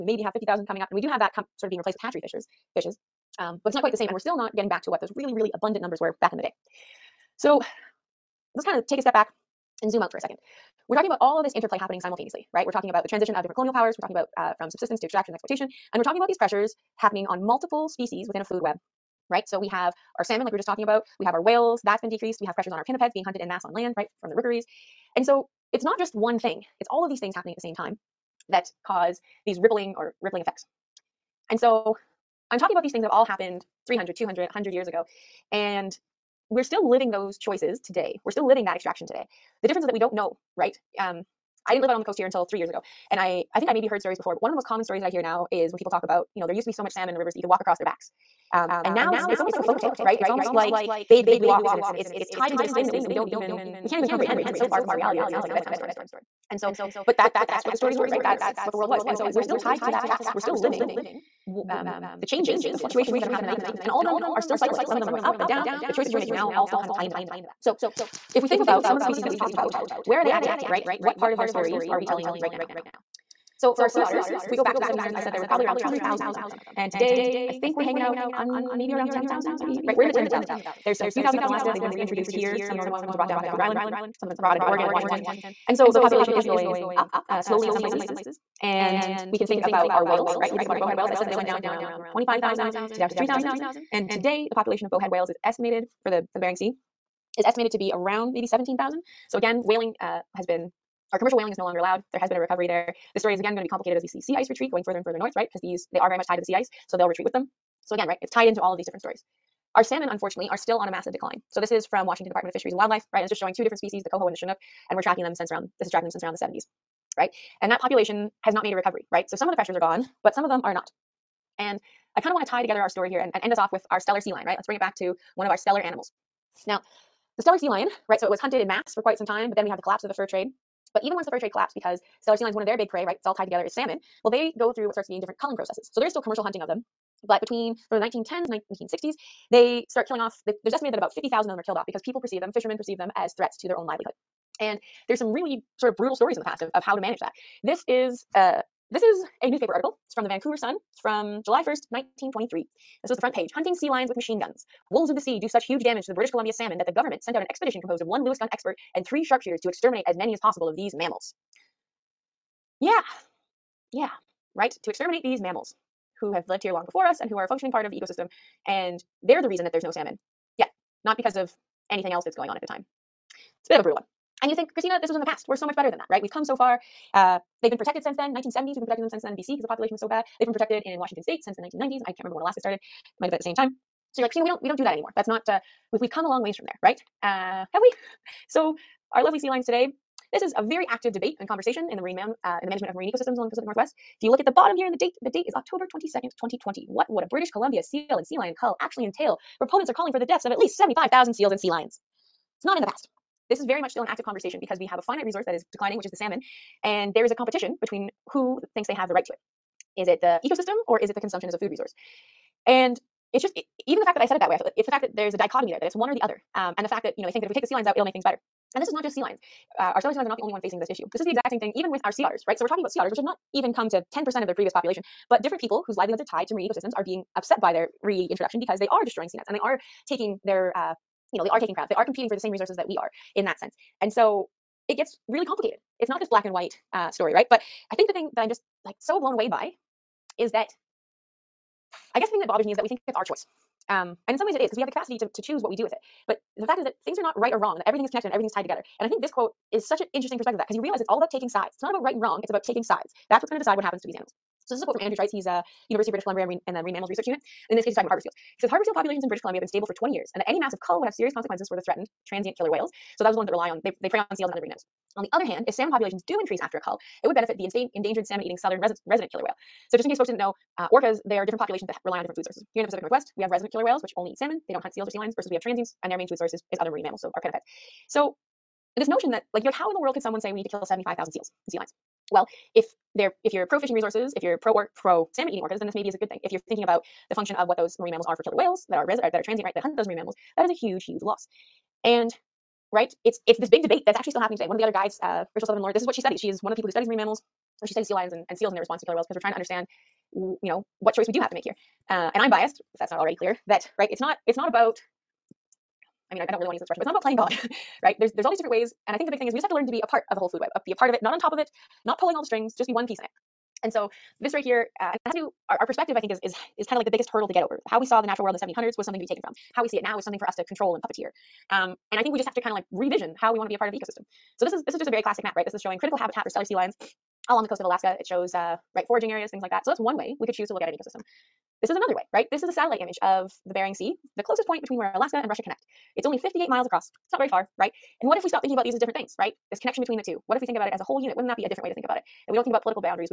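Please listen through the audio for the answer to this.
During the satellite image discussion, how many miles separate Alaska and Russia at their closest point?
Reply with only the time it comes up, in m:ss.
5:36.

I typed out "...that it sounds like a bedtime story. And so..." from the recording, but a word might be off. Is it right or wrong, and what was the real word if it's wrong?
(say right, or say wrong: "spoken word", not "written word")
right.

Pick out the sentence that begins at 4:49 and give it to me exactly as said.
That hunt those marine mammals, that is a huge, huge loss.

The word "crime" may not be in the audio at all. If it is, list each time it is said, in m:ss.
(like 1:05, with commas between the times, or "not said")
not said.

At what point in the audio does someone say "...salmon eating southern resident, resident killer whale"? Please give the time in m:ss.
4:28.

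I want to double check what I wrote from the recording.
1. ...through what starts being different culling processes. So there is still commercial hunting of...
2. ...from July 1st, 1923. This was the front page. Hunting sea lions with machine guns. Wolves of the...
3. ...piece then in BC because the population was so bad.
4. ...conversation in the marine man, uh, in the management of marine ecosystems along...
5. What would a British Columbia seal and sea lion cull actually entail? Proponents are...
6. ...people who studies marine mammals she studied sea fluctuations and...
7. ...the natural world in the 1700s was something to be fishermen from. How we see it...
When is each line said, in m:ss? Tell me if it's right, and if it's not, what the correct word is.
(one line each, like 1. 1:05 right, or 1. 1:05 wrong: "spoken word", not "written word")
1. 2:14 right
2. 2:31 right
3. 2:59 wrong: "since", not "piece"
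4. 3:11 right
5. 3:16 right
6. 4:56 wrong: "lions", not "fluctuations"
7. 5:18 wrong: "taken", not "fishermen".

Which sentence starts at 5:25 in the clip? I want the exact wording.
This is showing critical habitat for Steller sea lions along the coast of Alaska.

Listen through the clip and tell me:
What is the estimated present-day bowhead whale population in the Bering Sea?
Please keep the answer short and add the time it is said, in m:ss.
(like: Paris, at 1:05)
17,000, at 1:38.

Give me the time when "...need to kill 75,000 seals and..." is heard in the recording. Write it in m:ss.
4:40.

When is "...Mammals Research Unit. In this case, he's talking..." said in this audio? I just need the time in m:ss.
4:16.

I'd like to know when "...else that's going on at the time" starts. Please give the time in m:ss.
2:52.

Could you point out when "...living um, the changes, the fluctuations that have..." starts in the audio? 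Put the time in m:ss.
1:00.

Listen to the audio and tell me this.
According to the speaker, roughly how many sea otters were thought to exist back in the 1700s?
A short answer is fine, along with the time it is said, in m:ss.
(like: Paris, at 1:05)
200,000, at 1:15.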